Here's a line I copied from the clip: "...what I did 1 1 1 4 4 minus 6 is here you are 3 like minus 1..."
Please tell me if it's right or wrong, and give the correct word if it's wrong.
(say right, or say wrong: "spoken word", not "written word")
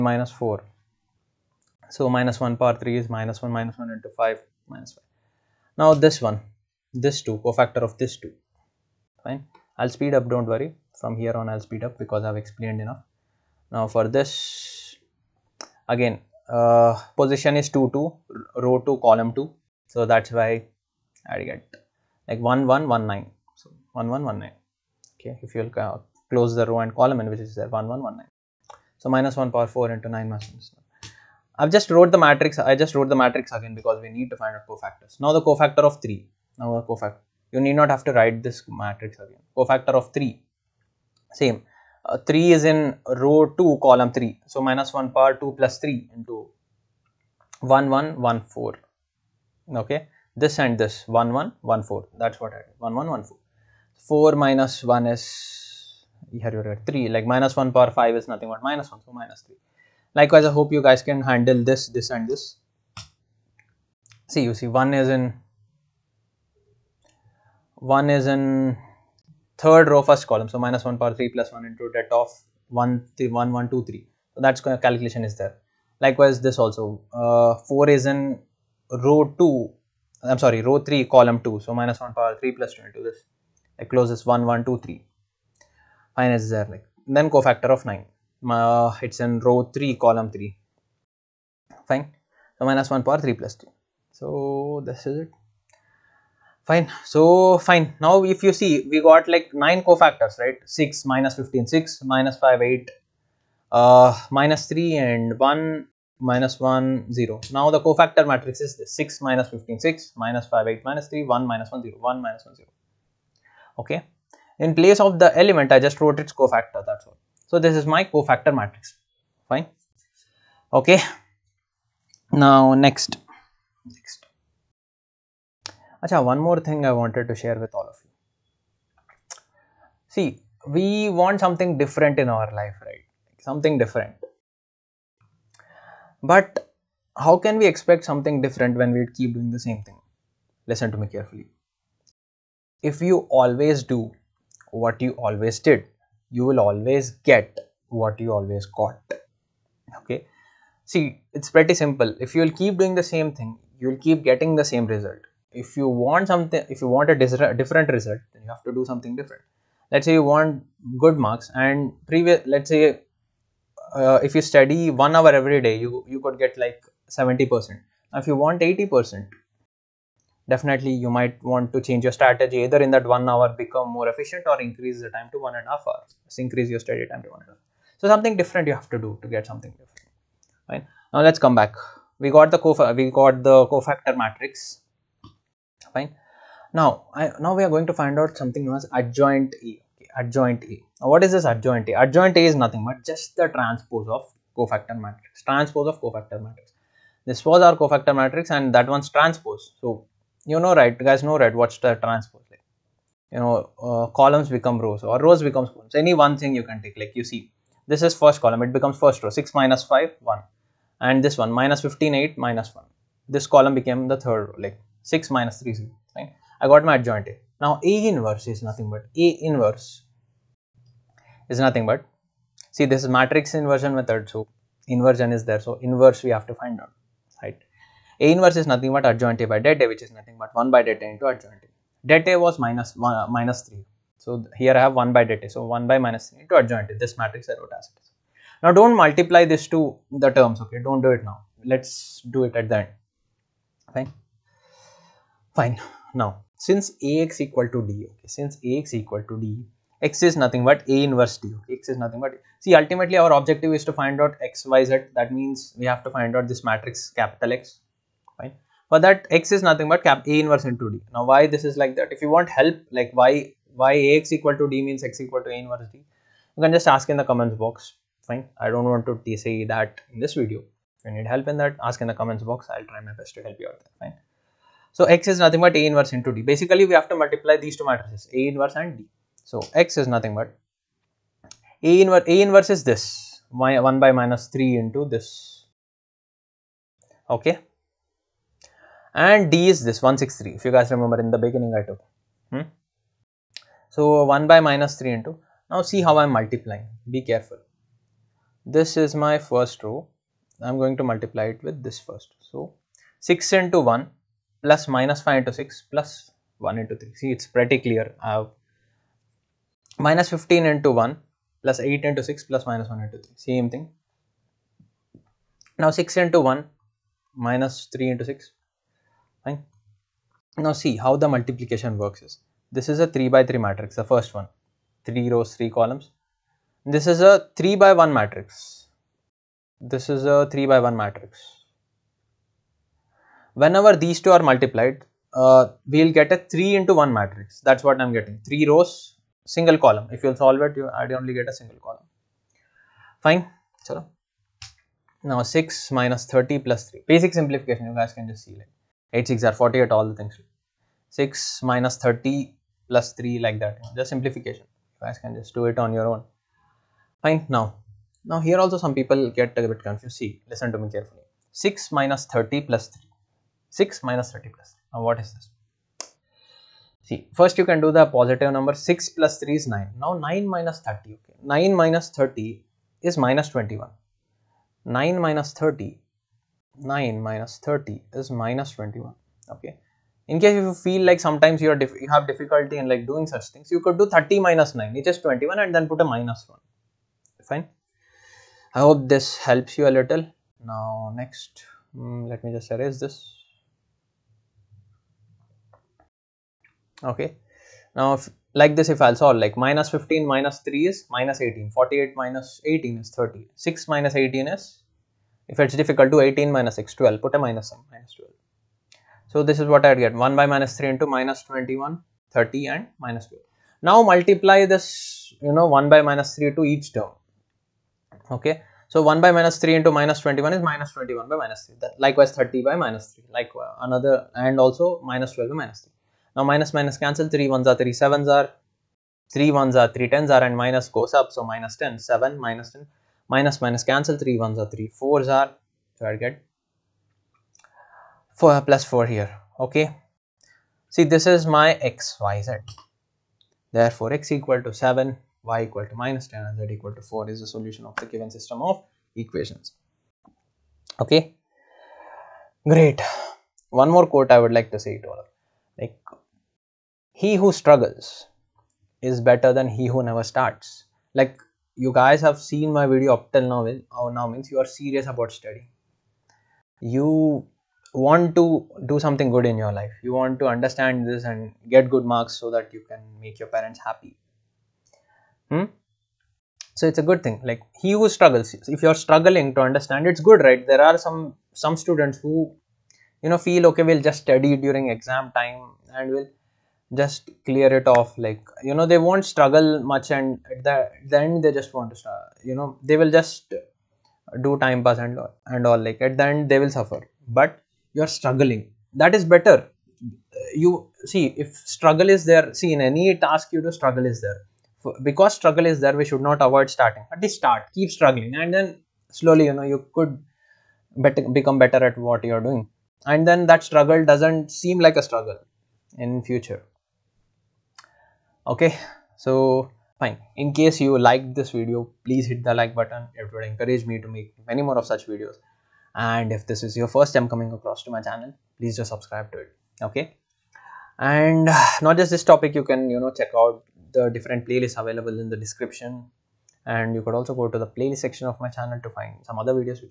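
wrong: "1", not "6".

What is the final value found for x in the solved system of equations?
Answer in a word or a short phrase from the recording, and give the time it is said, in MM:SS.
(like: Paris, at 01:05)
7, at 07:24.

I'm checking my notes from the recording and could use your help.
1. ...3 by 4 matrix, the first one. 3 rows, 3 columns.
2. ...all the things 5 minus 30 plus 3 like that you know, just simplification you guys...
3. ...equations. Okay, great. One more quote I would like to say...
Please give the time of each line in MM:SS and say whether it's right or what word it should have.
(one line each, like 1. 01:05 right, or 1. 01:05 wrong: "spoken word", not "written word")
1. 05:23 wrong: "3", not "4"
2. 05:49 wrong: "6", not "5"
3. 07:29 right.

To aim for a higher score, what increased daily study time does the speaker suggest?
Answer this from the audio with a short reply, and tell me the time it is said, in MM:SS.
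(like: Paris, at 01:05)
One and a half hours, at 02:55.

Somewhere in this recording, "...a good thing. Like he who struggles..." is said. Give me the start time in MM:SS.
07:57.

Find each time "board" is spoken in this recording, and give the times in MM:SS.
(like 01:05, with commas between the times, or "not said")
not said.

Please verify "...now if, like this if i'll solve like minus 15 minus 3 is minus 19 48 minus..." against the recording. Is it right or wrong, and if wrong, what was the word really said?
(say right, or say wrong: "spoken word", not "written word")
wrong: "18", not "19".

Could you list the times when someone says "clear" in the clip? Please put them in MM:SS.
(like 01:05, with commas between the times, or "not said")
05:07, 08:07.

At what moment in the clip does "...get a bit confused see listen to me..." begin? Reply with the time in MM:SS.
05:59.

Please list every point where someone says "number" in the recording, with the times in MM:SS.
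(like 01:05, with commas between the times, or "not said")
06:08.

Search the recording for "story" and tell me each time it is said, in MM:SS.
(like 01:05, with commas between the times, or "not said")
not said.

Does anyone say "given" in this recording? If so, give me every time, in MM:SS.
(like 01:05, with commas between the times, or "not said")
07:28.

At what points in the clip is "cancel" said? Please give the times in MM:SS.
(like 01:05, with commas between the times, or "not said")
07:06, 07:13.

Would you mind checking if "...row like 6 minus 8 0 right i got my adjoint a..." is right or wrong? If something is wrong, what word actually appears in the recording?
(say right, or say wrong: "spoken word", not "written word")
wrong: "3", not "8".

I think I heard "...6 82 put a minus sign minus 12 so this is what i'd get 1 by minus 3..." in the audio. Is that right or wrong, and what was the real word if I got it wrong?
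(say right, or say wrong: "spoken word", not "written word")
wrong: "12", not "82".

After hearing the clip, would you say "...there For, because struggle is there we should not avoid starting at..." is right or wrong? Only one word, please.
right.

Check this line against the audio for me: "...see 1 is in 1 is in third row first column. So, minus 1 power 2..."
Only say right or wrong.
wrong.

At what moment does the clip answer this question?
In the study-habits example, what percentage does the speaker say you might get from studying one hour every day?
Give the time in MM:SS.
02:47.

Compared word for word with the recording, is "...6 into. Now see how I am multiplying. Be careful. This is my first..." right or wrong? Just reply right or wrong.
wrong.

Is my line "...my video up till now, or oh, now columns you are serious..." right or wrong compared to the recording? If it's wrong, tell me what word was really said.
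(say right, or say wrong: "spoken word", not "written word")
wrong: "means", not "columns".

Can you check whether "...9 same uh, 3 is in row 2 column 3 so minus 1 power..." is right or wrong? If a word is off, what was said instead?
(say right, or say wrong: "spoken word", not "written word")
wrong: "3", not "9".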